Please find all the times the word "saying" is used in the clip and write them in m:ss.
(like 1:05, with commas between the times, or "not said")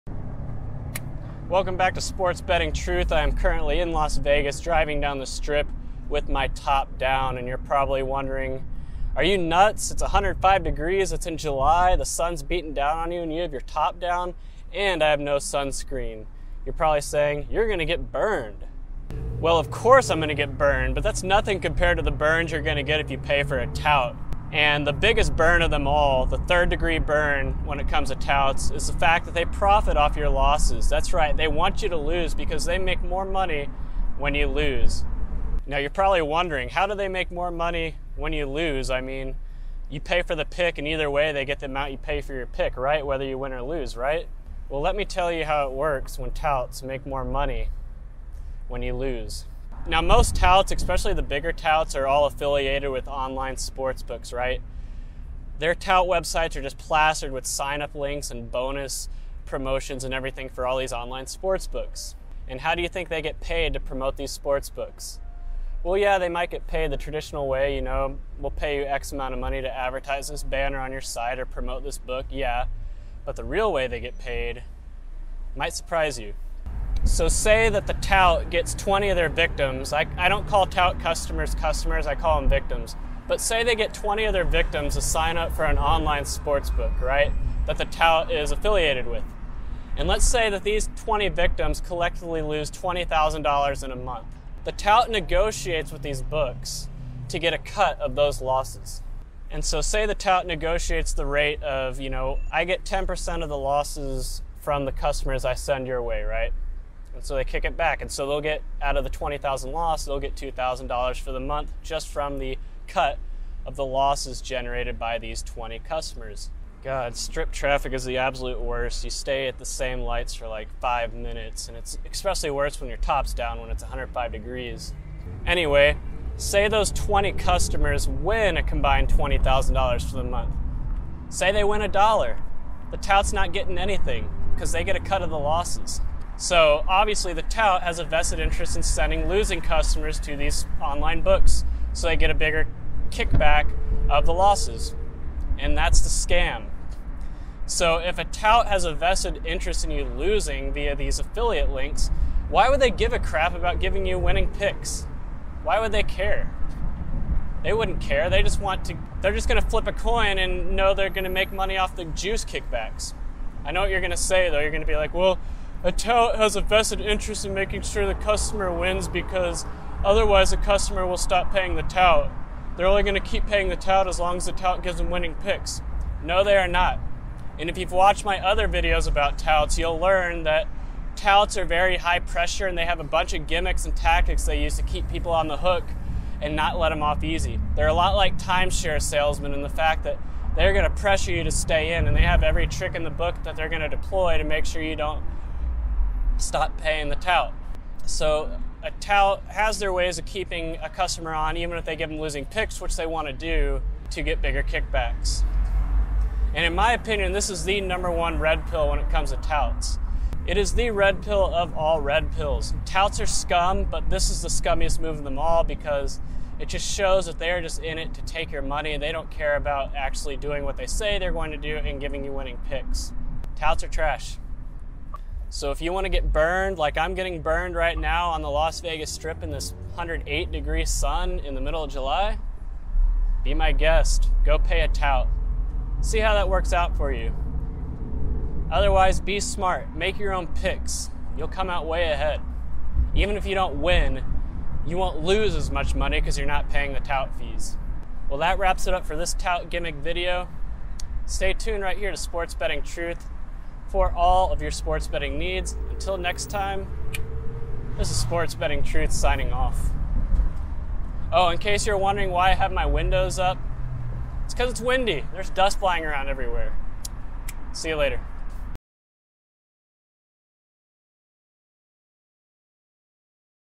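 0:17.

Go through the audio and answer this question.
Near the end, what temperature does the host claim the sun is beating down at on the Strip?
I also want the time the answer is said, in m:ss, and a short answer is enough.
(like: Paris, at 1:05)
108 degrees, at 3:49.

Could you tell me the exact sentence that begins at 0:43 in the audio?
Whether you win or lose, right?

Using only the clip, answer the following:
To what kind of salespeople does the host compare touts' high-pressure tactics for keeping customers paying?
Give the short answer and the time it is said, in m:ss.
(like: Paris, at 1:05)
timeshare salesmen, at 3:08.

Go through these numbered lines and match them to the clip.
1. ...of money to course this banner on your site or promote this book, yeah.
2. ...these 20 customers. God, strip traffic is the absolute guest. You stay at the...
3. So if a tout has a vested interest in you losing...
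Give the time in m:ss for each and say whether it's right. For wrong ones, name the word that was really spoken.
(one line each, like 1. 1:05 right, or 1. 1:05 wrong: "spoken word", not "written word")
1. 1:09 wrong: "advertise", not "course"
2. 1:55 wrong: "worst", not "guest"
3. 2:27 right.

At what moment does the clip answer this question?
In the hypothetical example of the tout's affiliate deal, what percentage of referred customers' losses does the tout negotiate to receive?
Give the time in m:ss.
1:42.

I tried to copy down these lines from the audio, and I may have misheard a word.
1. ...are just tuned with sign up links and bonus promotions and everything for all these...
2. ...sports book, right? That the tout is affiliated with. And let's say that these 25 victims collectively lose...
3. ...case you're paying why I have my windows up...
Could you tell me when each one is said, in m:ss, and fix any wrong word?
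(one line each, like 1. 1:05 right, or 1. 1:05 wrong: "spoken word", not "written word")
1. 0:56 wrong: "plastered", not "tuned"
2. 1:26 wrong: "20", not "25"
3. 4:21 wrong: "wondering", not "paying".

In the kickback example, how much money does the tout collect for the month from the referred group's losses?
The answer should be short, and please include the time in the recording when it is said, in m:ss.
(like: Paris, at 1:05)
$2,000, at 1:50.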